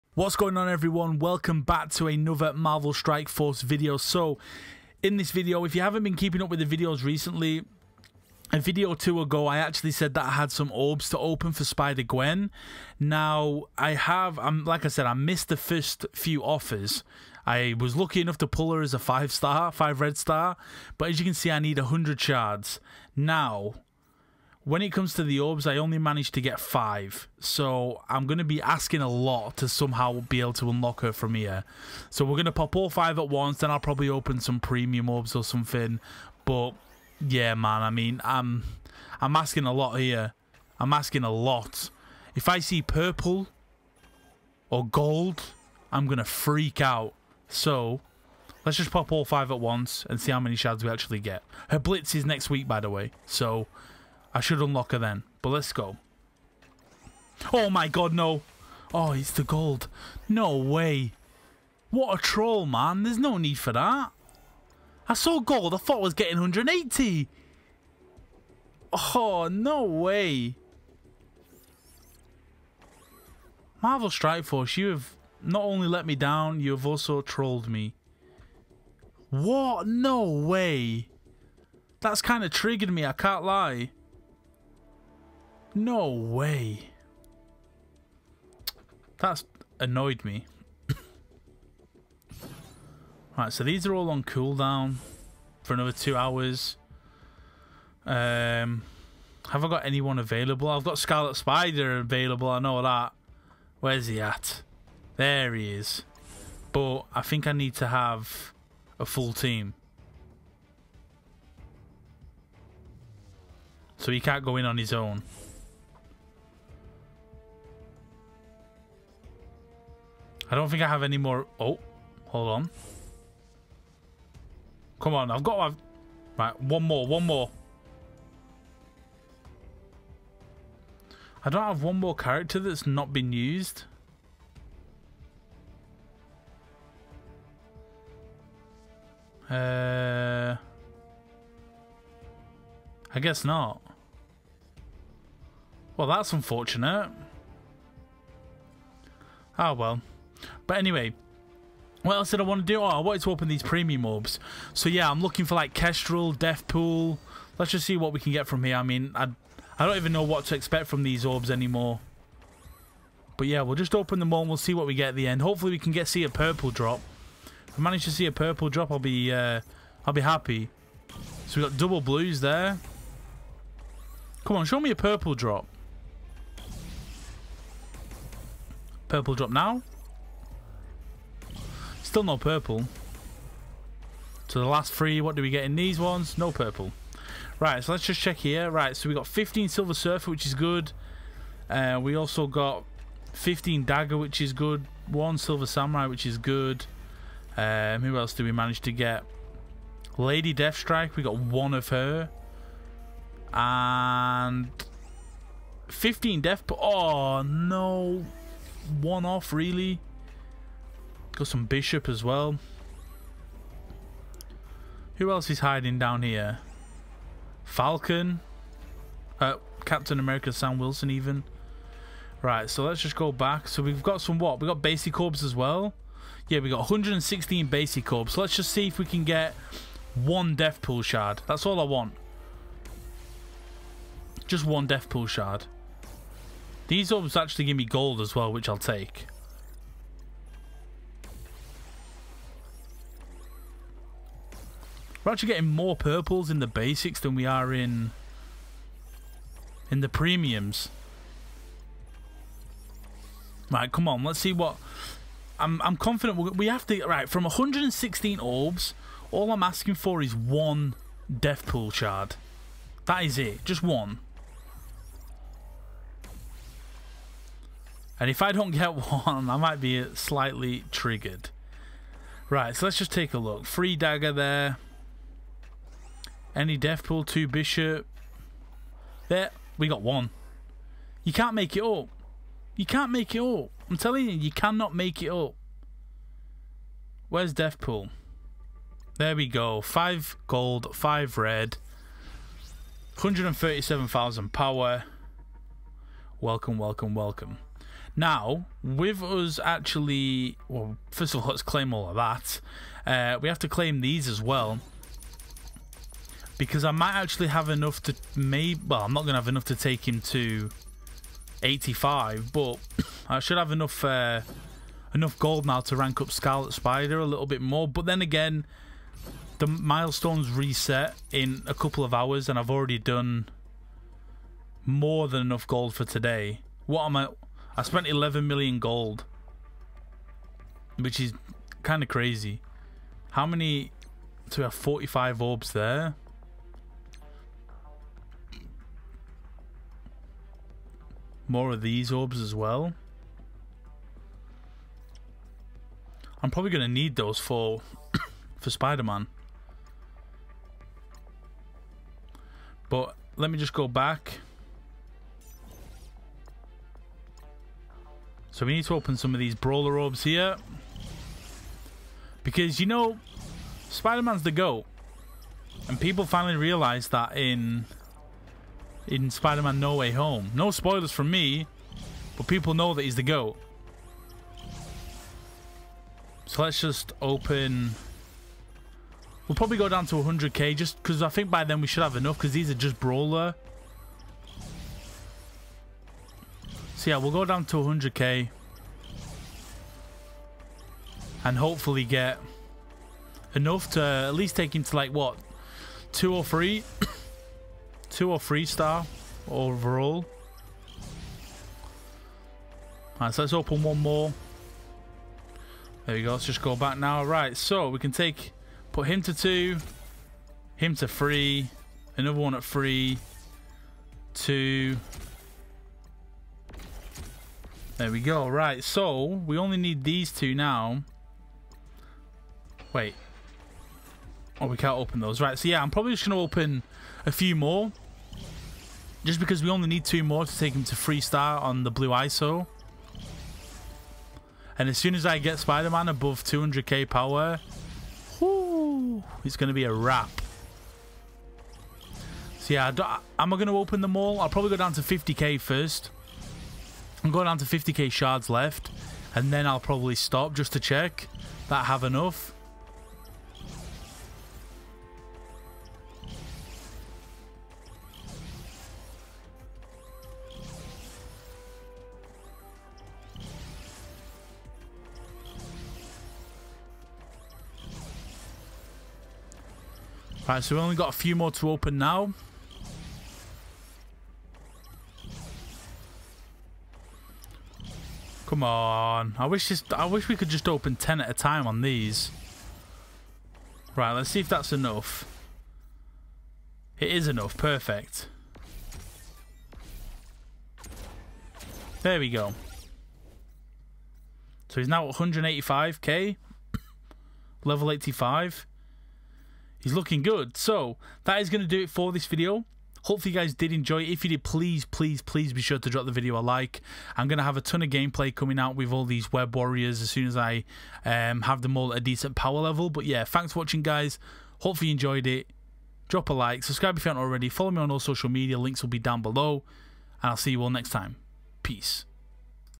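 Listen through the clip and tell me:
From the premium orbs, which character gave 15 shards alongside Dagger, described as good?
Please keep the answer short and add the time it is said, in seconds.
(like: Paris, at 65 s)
Silver Surfer, at 189 s.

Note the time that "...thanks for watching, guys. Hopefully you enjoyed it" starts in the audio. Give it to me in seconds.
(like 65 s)
513 s.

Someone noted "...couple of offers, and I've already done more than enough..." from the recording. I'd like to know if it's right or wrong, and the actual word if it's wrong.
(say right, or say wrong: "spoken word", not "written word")
wrong: "hours", not "offers".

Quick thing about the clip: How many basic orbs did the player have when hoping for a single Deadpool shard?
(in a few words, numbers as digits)
116.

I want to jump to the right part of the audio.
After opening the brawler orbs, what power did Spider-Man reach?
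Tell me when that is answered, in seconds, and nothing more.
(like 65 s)
495 s.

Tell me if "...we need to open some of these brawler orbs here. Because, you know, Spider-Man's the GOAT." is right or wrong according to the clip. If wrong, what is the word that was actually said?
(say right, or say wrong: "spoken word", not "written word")
right.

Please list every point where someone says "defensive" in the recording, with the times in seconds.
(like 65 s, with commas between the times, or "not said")
not said.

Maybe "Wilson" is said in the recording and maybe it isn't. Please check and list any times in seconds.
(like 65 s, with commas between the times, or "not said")
220 s.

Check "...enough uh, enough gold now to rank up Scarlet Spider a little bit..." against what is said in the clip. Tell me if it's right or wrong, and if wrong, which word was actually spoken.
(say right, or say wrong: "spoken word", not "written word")
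right.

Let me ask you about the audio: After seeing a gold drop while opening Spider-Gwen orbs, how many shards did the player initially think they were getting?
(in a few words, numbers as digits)
180.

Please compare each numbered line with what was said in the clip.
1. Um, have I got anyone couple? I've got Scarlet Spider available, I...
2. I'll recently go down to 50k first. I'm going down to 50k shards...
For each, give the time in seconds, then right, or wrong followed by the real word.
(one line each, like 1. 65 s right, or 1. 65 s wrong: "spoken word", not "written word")
1. 98 s wrong: "available", not "couple"
2. 444 s wrong: "probably", not "recently".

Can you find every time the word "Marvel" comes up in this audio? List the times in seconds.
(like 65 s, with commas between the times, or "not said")
2 s, 73 s.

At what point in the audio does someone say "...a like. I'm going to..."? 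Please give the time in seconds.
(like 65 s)
506 s.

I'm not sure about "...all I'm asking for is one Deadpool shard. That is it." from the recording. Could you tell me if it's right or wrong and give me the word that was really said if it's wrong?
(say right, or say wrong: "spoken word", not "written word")
right.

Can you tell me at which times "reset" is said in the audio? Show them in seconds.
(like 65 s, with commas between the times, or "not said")
320 s.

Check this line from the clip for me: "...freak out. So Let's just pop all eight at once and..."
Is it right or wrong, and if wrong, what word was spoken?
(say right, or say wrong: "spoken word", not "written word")
wrong: "five", not "eight".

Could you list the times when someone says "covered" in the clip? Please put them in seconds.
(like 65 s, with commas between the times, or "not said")
not said.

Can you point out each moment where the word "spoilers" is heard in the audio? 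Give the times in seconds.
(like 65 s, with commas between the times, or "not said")
370 s.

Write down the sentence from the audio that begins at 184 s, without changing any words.
So the last three, what do we get in these ones?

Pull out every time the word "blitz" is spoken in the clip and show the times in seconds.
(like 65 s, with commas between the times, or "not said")
51 s.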